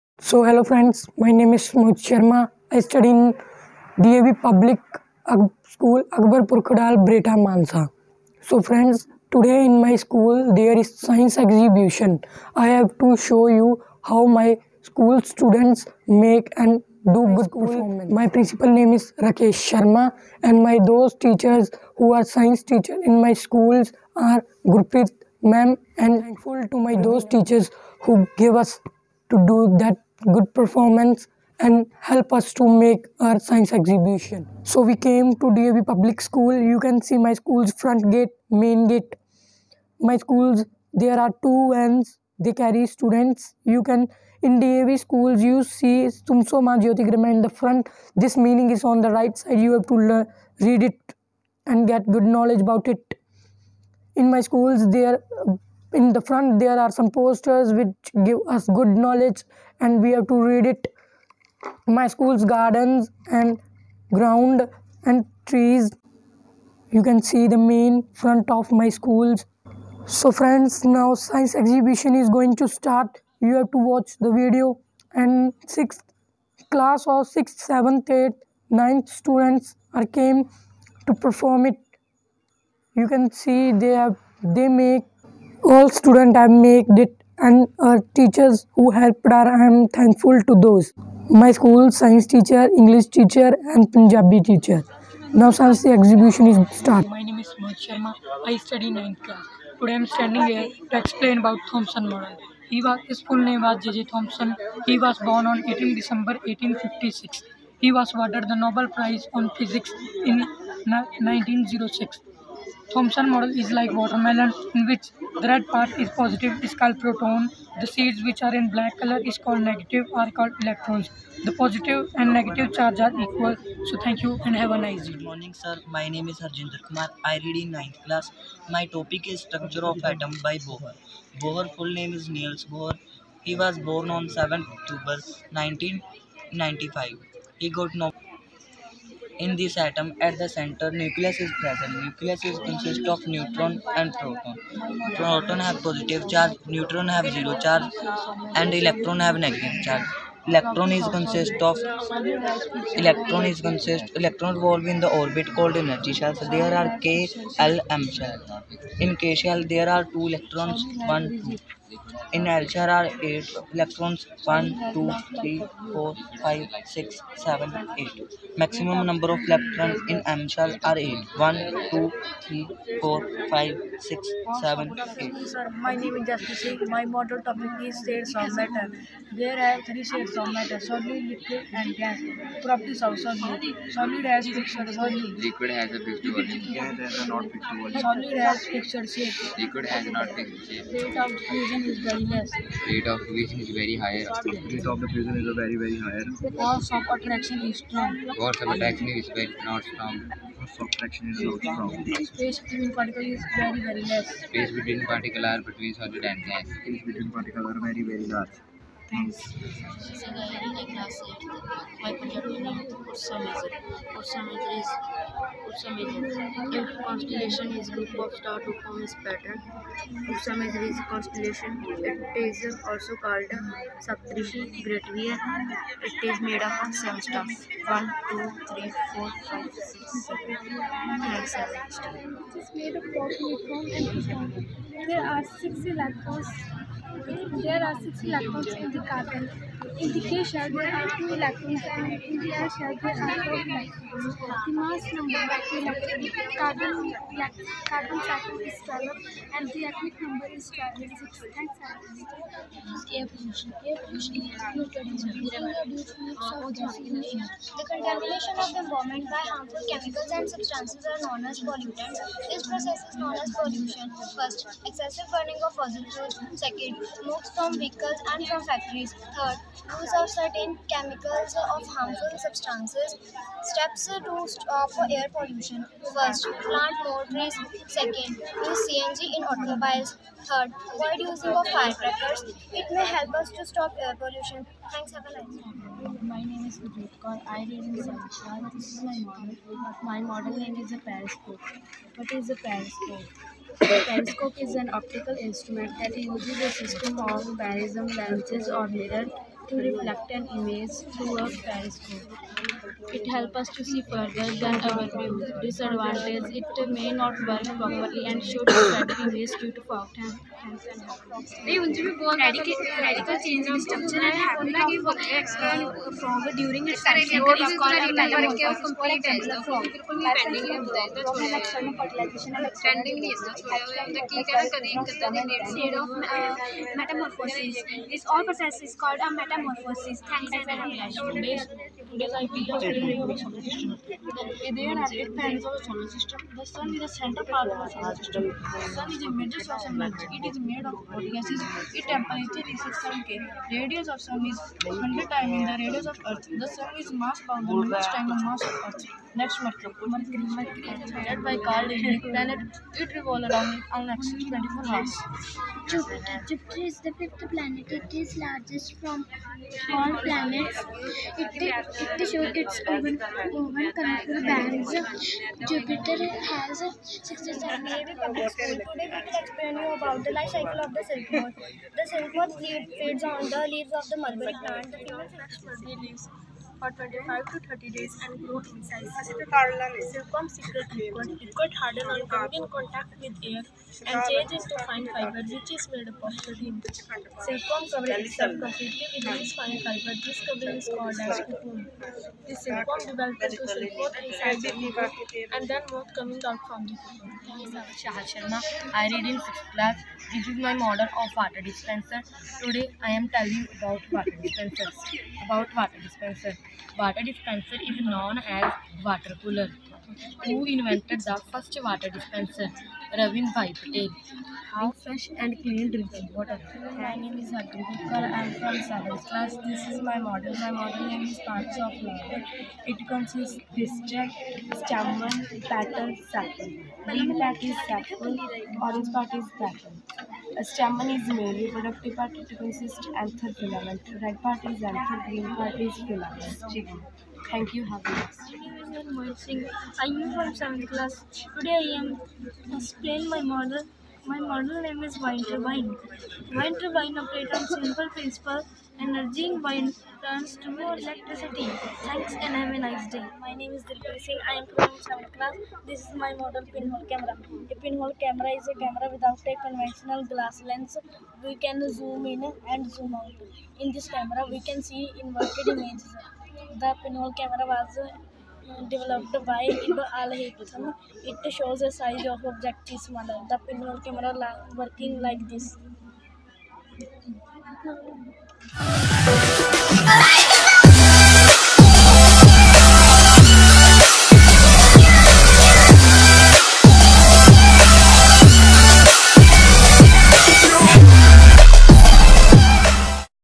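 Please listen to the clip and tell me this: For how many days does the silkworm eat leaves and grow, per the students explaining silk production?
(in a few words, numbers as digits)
25 to 30 days.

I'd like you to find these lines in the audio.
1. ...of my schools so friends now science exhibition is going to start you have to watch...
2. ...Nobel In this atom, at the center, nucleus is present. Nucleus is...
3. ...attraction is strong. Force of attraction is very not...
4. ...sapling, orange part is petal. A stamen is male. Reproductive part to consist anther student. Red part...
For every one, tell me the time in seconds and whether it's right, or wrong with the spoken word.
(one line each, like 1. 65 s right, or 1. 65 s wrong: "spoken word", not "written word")
1. 68 s right
2. 137 s right
3. 197 s right
4. 427 s wrong: "filament", not "student".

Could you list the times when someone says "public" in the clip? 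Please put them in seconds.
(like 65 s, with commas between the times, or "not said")
4 s, 35 s, 367 s.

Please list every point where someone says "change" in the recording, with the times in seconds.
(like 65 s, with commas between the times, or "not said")
313 s, 384 s.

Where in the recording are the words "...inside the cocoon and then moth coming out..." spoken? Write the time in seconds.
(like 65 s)
394 s.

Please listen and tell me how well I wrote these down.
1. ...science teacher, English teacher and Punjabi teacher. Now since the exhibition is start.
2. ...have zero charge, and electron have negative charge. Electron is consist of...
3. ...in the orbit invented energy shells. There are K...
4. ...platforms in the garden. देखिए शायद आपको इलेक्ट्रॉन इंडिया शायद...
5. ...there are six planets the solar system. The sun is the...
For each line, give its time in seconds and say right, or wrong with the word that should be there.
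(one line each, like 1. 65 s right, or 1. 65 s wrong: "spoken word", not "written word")
1. 91 s right
2. 147 s right
3. 154 s wrong: "called", not "invented"
4. 238 s right
5. 334 s wrong: "eight", not "six".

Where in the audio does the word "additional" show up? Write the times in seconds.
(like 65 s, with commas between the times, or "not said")
not said.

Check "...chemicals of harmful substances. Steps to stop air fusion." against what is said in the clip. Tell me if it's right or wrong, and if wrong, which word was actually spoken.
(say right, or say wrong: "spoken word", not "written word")
wrong: "pollution", not "fusion".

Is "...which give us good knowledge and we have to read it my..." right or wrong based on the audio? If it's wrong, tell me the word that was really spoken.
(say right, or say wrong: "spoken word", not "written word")
right.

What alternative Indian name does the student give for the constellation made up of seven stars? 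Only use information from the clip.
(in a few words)
Saptrishi.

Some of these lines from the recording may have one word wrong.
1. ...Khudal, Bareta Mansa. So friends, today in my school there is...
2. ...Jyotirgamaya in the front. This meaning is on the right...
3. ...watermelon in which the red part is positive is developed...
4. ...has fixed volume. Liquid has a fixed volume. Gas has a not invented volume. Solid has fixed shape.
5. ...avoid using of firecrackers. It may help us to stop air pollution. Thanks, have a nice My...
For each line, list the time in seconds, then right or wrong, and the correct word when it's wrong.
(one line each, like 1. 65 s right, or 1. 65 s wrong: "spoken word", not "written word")
1. 6 s right
2. 46 s right
3. 113 s wrong: "called", not "developed"
4. 184 s wrong: "fixed", not "invented"
5. 280 s right.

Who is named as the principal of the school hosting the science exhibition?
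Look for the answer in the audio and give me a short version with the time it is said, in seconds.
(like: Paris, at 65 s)
Rakesh Sharma, at 19 s.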